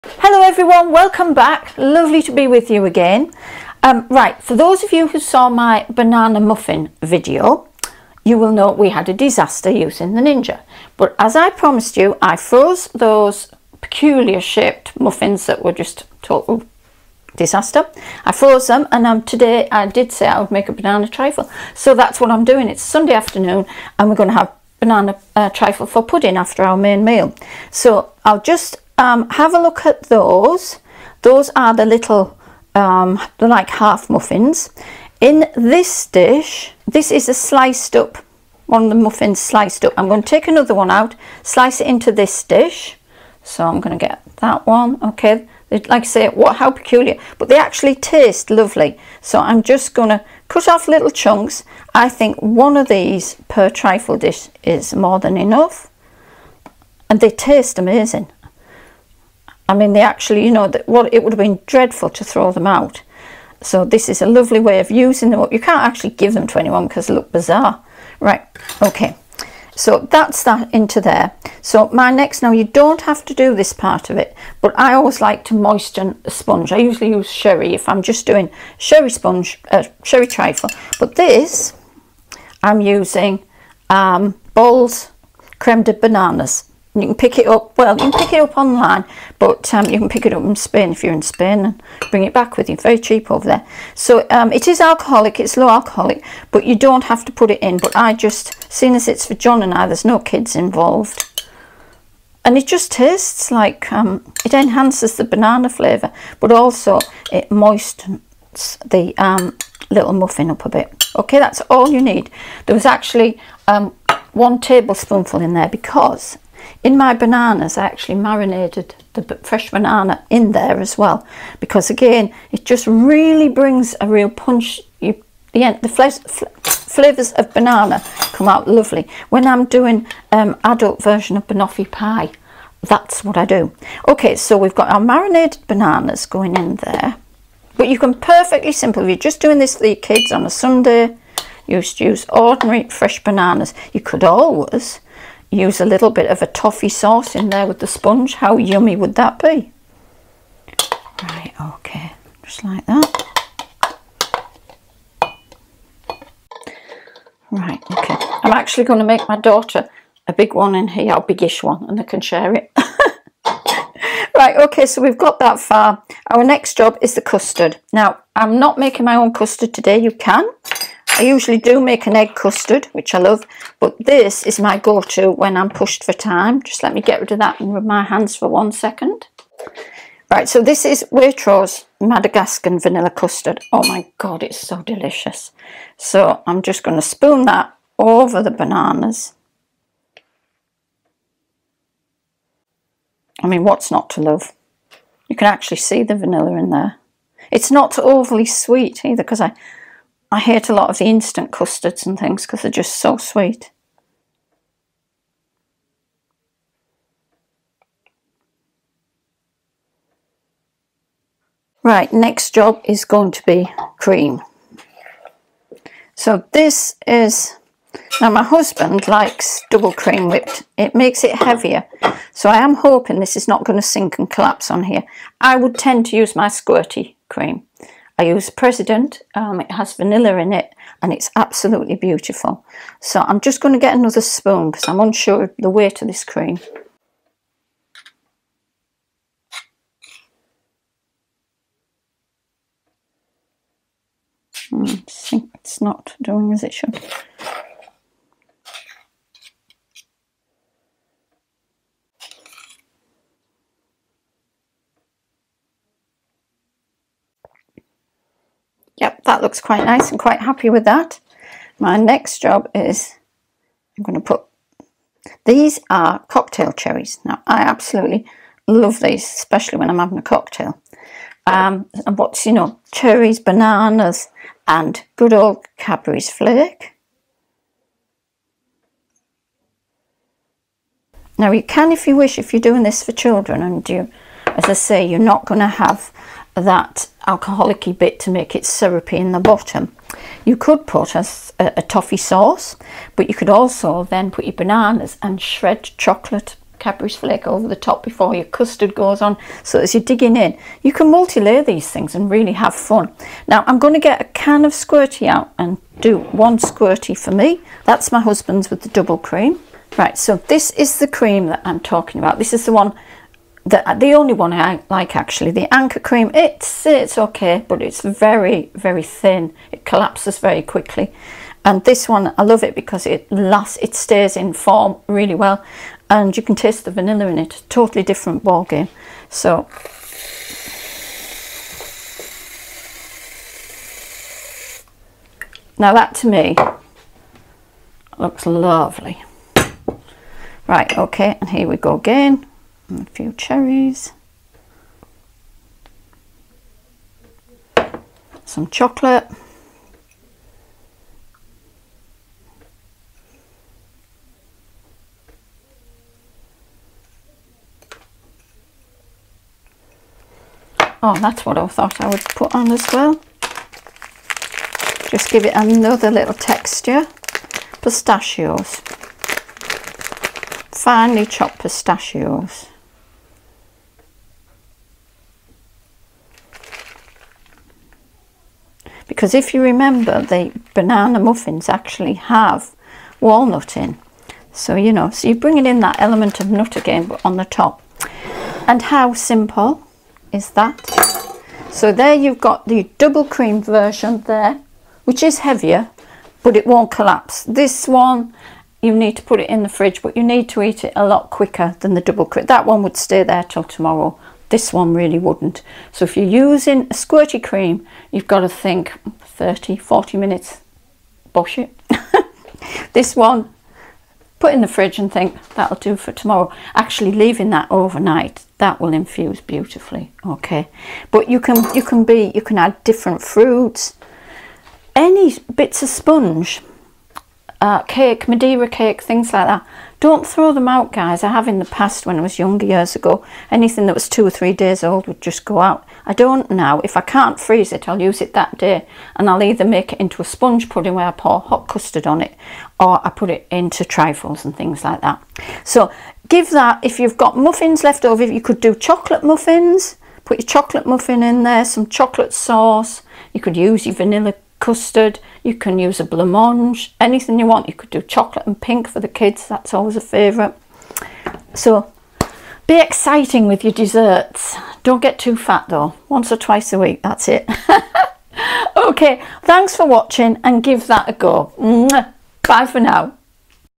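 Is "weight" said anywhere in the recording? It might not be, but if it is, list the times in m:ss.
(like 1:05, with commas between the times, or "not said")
3:55.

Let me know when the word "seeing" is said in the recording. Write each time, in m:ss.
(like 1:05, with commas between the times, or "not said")
1:38.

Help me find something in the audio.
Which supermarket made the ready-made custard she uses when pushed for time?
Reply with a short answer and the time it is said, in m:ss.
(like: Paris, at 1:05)
Waitrose, at 3:01.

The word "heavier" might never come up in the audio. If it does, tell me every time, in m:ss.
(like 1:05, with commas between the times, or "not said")
3:41, 6:35.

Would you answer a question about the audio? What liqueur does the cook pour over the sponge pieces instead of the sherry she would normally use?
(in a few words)
Creme de bananas.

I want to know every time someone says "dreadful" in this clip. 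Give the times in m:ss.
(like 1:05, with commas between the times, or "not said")
1:01.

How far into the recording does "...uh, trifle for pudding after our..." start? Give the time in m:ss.
0:25.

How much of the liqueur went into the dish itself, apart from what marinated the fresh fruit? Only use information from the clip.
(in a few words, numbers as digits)
1 tablespoon.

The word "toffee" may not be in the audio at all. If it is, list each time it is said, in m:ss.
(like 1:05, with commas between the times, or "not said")
2:26, 4:51.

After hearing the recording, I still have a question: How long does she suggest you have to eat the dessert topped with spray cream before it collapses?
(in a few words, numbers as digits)
30 to 40 minutes.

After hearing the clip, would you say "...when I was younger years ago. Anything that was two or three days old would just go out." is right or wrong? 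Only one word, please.
right.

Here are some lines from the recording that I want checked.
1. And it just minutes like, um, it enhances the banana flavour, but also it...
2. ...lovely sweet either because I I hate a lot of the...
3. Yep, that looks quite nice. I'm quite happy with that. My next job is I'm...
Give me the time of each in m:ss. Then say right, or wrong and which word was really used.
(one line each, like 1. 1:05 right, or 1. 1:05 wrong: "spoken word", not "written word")
1. 1:42 wrong: "tastes", not "minutes"
2. 3:17 wrong: "overly", not "lovely"
3. 4:19 right.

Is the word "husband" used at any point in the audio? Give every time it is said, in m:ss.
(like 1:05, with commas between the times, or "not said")
3:38, 5:08.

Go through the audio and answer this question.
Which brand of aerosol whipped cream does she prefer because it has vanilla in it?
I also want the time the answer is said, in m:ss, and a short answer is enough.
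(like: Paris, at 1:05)
President, at 3:48.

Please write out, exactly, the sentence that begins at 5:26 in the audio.
And you can taste the vanilla in it.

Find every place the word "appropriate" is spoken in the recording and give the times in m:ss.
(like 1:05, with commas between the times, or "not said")
not said.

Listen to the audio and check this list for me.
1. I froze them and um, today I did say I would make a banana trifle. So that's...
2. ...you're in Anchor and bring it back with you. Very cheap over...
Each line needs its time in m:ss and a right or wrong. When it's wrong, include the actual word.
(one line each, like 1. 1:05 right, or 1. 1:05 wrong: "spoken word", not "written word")
1. 0:18 right
2. 1:31 wrong: "Spain", not "Anchor".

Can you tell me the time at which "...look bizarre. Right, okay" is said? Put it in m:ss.
1:07.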